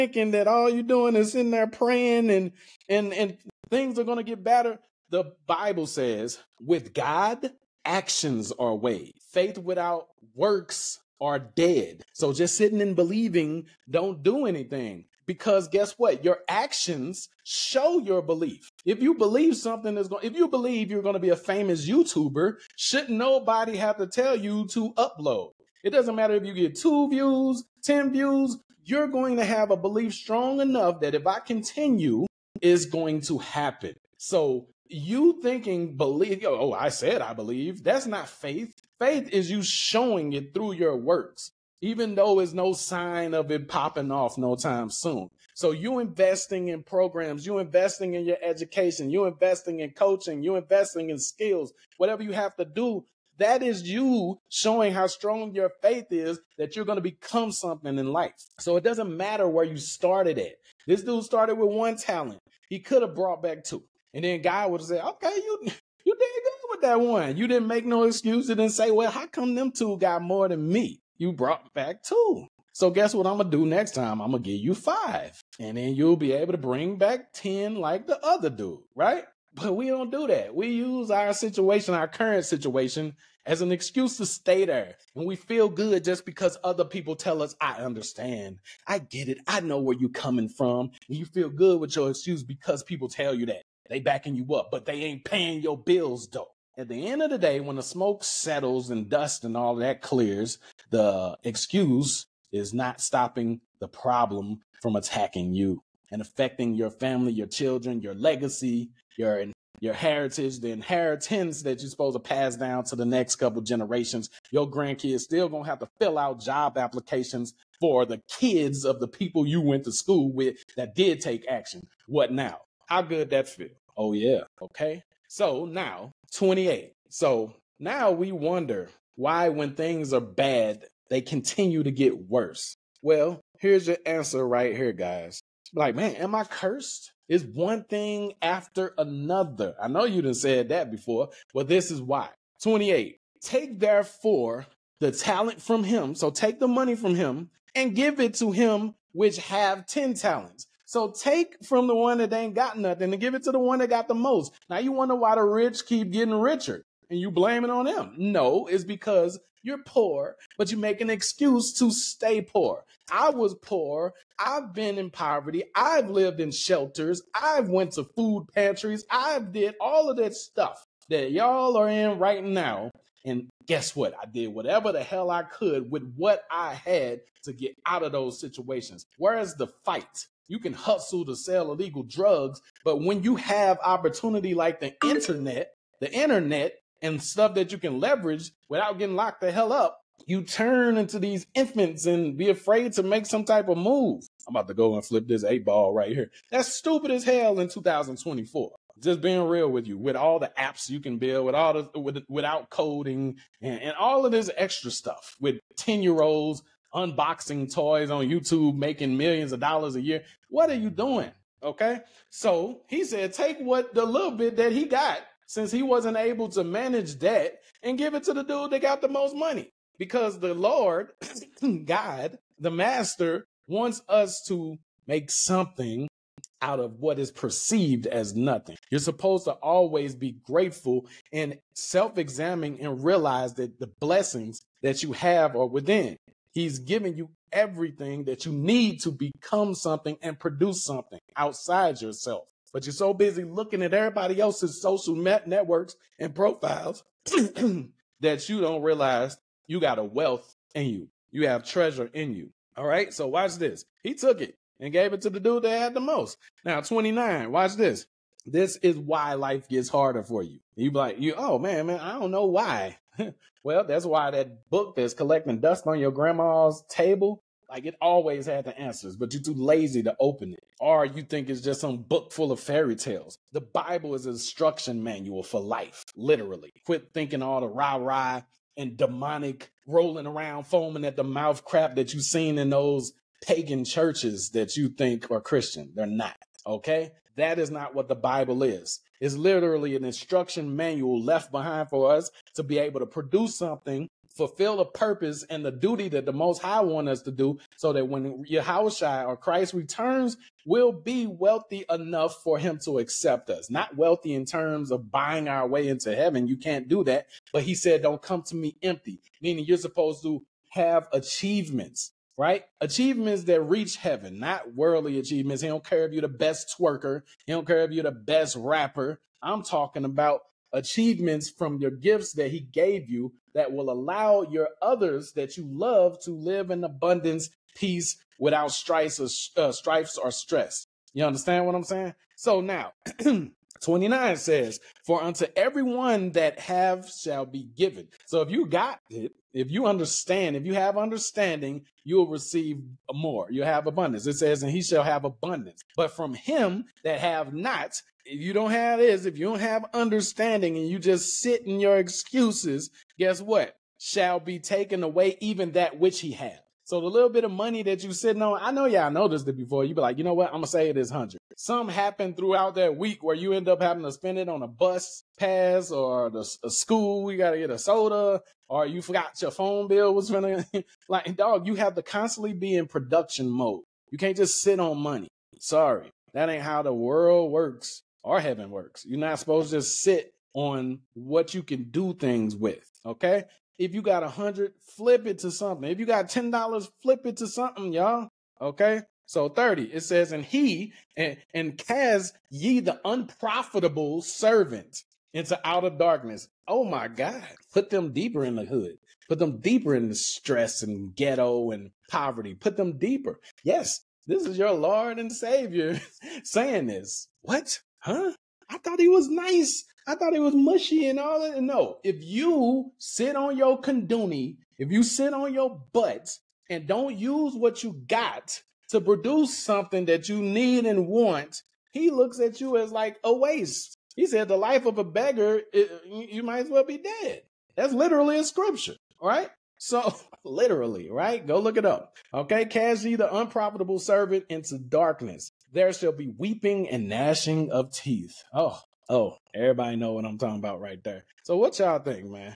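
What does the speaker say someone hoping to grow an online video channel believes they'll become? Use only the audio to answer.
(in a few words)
famous YouTuber.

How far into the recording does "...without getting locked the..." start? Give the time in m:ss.
3:08.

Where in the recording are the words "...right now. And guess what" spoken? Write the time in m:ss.
2:52.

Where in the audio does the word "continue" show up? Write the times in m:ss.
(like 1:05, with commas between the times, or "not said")
0:31, 2:11.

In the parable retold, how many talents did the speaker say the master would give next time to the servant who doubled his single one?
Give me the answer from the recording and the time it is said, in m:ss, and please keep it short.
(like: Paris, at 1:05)
5, at 1:14.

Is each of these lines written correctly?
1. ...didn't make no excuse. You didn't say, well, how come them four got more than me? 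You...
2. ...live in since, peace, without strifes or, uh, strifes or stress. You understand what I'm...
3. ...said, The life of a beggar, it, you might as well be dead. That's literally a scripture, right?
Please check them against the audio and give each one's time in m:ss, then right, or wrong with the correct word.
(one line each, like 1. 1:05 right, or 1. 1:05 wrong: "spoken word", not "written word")
1. 1:07 wrong: "two", not "four"
2. 5:26 wrong: "abundance", not "since"
3. 7:04 right.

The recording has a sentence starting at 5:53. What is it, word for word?
Shall be taken away even that which he has.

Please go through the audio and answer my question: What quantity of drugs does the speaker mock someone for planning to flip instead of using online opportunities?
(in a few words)
eight ball.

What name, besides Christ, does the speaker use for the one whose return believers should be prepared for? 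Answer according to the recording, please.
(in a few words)
Yahushua.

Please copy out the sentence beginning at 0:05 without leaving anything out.
The Bible says, with God, actions are ways.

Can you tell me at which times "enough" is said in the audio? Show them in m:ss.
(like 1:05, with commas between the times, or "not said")
0:30, 5:01.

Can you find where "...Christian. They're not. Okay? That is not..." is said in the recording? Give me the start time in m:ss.
4:45.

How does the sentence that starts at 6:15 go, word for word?
Sorry, that ain't how the world works or heaven works.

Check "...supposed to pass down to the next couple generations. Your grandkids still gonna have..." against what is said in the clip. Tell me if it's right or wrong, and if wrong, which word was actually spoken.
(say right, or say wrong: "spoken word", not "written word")
right.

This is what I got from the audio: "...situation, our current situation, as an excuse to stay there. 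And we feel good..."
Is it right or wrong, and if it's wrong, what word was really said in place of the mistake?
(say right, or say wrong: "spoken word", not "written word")
right.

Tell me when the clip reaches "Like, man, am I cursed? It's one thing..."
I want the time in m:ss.
2:15.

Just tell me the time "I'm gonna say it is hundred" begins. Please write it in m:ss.
6:00.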